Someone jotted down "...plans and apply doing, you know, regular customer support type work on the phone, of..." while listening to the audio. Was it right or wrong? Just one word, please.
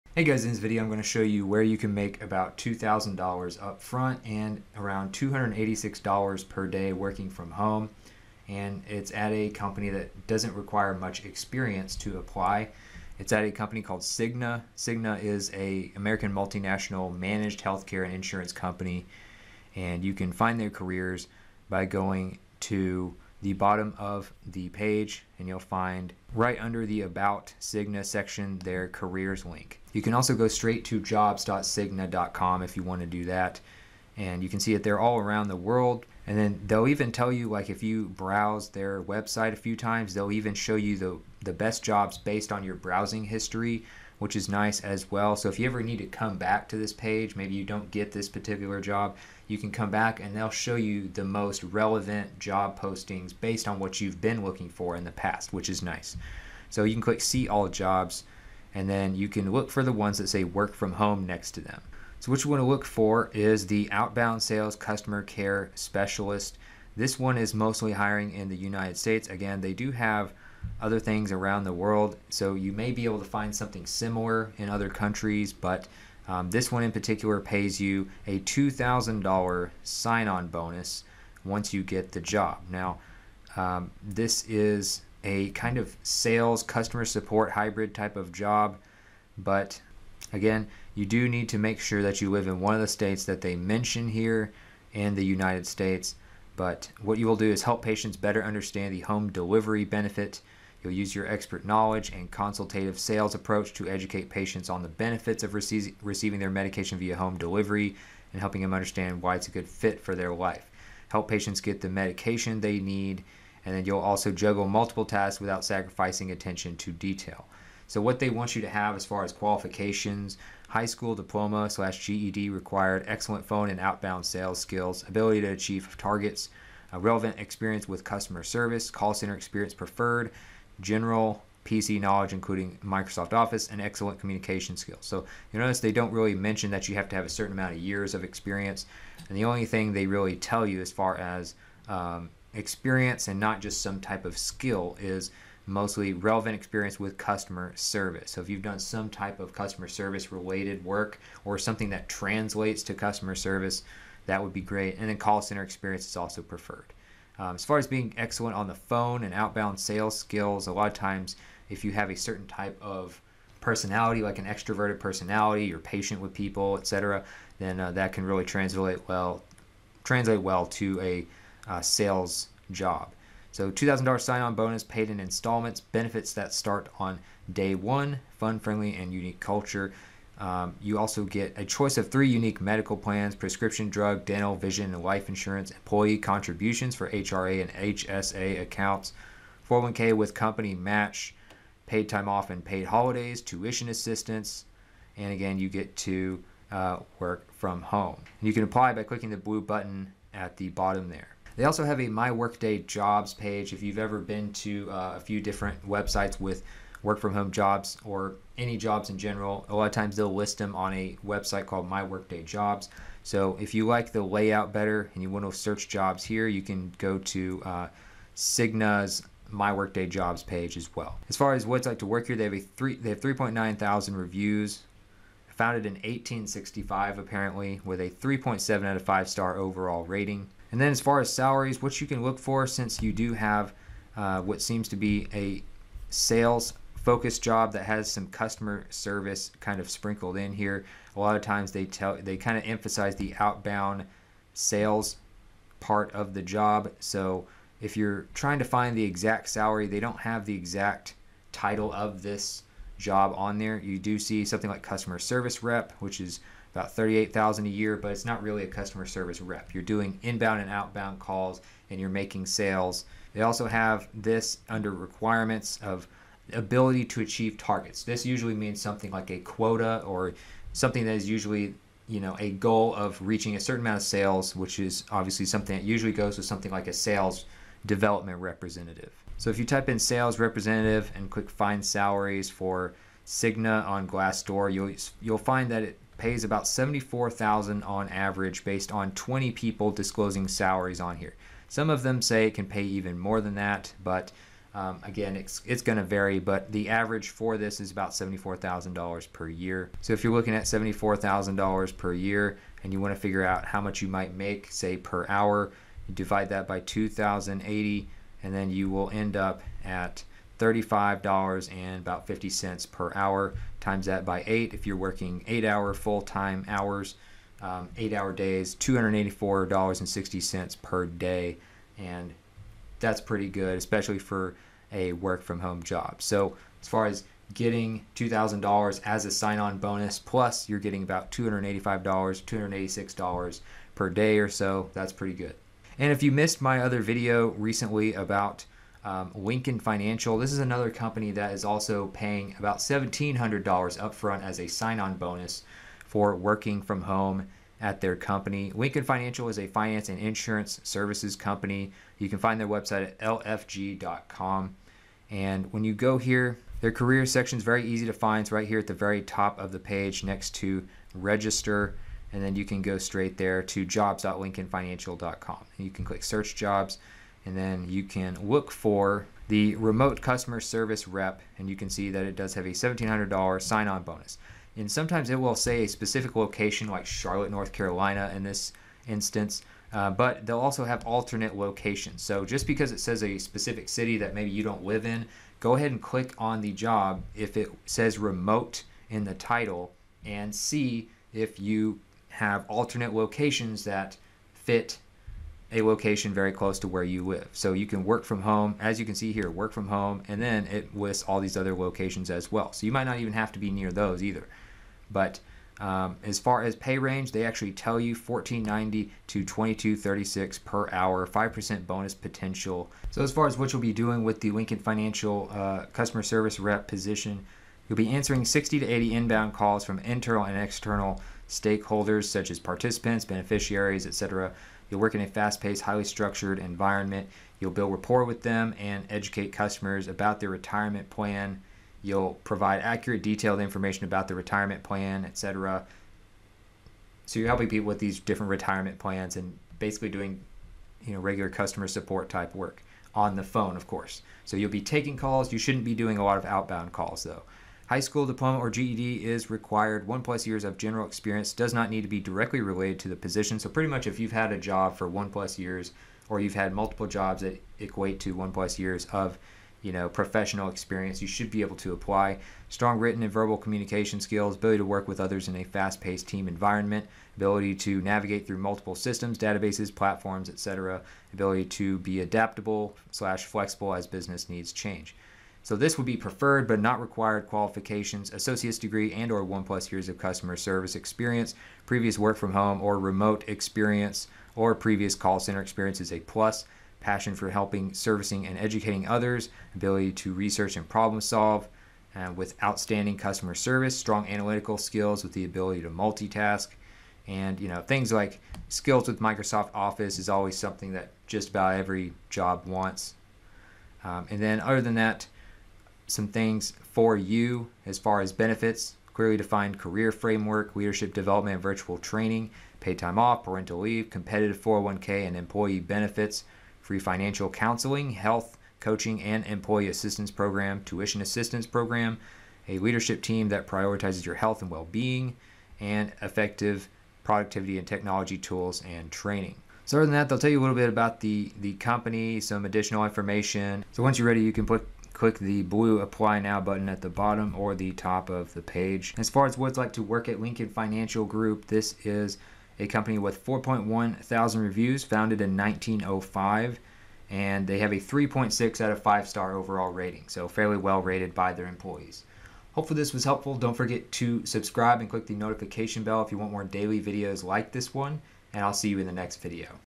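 wrong.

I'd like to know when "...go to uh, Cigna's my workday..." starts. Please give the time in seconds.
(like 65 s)
216 s.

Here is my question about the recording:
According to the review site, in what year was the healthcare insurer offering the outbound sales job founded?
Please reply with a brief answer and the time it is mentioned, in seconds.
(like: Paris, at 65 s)
1865, at 225 s.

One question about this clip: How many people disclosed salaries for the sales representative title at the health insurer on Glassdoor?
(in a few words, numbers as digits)
20.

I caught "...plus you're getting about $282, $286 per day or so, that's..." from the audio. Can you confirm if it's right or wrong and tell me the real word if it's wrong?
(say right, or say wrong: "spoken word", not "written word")
wrong: "285", not "282".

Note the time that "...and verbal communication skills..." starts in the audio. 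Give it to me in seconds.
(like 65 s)
463 s.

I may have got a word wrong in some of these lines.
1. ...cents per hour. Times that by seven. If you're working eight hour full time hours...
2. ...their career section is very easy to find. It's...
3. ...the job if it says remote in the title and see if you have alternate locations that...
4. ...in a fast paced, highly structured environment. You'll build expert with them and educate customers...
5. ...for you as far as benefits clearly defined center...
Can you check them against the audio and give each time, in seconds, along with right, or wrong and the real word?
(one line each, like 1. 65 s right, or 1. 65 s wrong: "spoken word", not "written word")
1. 312 s wrong: "eight", not "seven"
2. 356 s right
3. 386 s right
4. 425 s wrong: "rapport", not "expert"
5. 506 s wrong: "career", not "center".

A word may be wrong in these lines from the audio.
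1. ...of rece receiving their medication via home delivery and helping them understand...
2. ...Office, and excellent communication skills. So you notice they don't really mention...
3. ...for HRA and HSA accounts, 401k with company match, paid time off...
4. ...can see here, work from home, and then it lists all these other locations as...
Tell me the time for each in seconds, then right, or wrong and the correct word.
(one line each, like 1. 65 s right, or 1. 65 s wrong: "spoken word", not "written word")
1. 105 s right
2. 133 s right
3. 186 s right
4. 399 s right.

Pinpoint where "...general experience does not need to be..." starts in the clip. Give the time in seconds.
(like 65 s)
450 s.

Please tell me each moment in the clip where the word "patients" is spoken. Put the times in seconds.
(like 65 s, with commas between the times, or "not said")
97 s, 104 s, 111 s, 165 s.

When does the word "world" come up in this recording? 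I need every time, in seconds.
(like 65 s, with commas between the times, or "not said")
35 s, 71 s.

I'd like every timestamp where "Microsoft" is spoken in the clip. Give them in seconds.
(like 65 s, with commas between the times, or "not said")
132 s, 499 s.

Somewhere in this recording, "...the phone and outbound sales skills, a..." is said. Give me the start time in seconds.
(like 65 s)
158 s.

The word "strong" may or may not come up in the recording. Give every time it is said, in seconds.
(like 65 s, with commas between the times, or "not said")
462 s, 493 s.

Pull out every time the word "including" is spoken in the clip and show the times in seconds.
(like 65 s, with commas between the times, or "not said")
132 s.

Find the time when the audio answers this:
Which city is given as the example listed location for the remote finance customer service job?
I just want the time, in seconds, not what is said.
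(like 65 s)
377 s.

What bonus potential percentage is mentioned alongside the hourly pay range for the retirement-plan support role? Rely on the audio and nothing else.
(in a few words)
5%.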